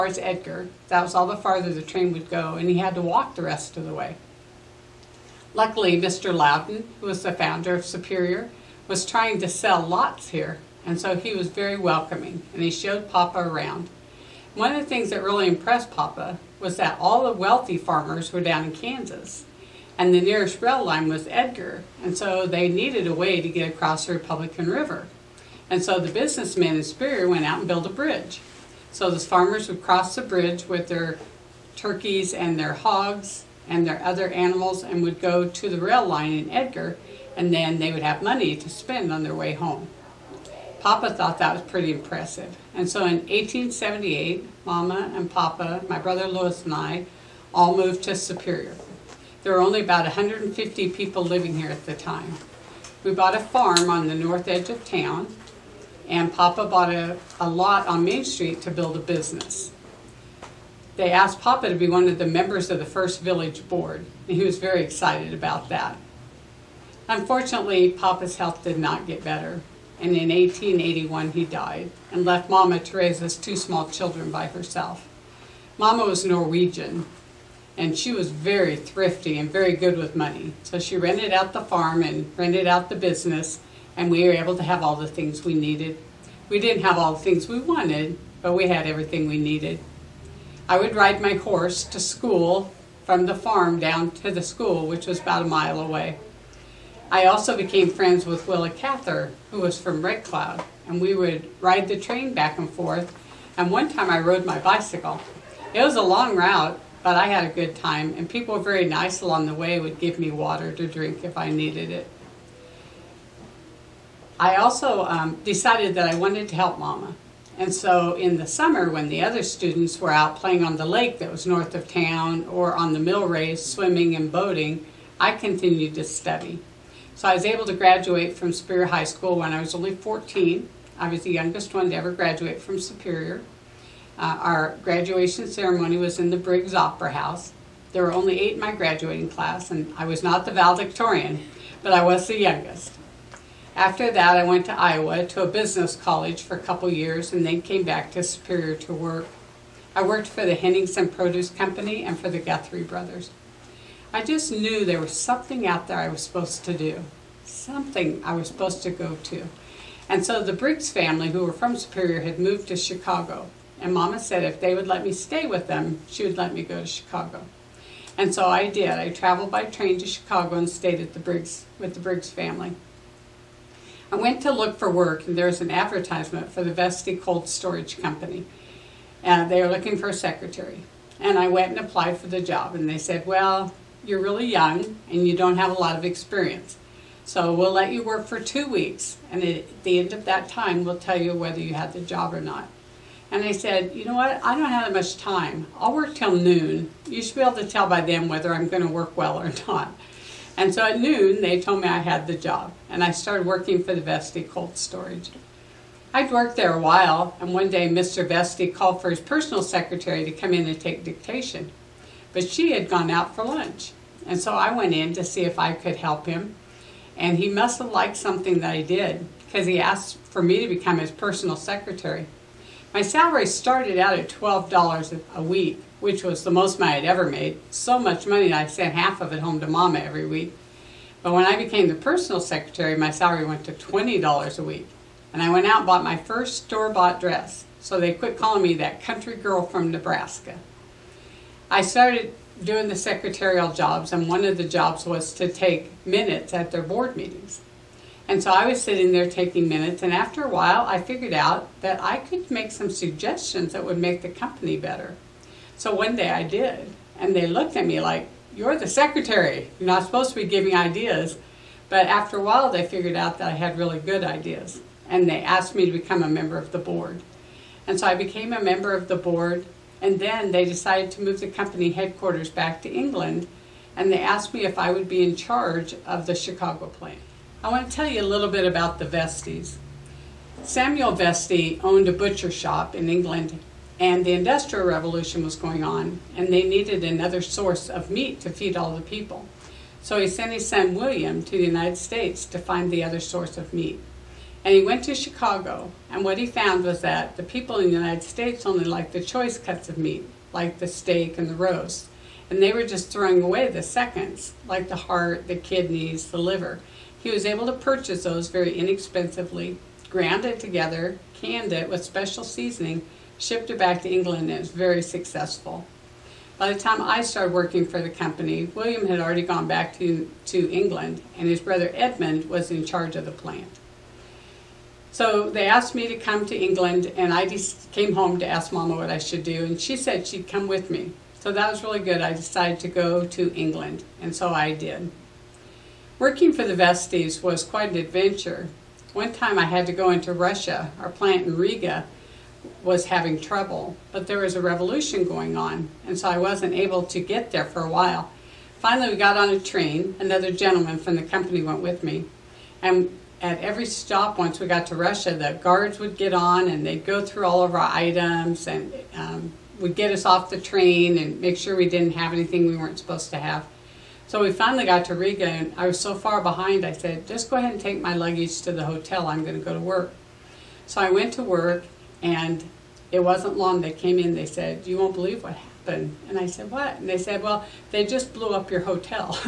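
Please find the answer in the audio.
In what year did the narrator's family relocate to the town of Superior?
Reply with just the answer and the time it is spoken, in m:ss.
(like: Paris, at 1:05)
1878, at 0:43.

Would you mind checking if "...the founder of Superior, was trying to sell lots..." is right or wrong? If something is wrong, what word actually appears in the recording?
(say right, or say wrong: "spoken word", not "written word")
right.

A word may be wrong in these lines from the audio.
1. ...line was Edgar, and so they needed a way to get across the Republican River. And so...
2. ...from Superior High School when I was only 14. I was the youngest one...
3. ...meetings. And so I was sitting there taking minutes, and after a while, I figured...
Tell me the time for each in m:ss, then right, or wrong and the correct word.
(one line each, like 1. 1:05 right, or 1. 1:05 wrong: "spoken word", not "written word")
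1. 0:20 right
2. 2:08 right
3. 4:07 right.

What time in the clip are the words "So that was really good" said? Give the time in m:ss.
5:31.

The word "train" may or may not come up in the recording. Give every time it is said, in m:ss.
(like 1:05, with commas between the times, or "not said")
0:01, 1:41, 2:49, 5:49, 6:00.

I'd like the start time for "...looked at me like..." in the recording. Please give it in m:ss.
4:17.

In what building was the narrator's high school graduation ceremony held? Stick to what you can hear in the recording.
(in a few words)
Briggs Opera House.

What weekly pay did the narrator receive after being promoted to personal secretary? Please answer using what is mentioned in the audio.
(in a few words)
$20 a week.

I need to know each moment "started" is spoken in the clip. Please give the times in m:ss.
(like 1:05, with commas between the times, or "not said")
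3:23, 3:43, 4:01, 5:17.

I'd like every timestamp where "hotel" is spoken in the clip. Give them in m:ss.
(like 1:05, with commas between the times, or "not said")
6:08, 6:18.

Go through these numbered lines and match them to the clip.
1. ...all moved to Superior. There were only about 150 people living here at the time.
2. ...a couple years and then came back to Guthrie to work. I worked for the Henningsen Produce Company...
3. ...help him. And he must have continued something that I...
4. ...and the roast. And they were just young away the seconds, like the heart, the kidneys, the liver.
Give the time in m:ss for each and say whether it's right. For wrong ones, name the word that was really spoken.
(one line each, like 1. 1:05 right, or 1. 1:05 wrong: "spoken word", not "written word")
1. 0:47 right
2. 2:26 wrong: "Superior", not "Guthrie"
3. 3:35 wrong: "liked", not "continued"
4. 5:01 wrong: "throwing", not "young".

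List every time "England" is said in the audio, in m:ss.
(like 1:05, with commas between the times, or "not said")
4:32, 4:43, 5:14, 5:20, 5:26, 5:33.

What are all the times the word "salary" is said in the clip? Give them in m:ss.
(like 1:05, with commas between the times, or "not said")
3:43, 3:53.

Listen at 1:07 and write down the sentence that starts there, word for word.
Unfortunately, Papa's health did not get better, and in 1881 he died and left Mama Teresa's two small children by herself.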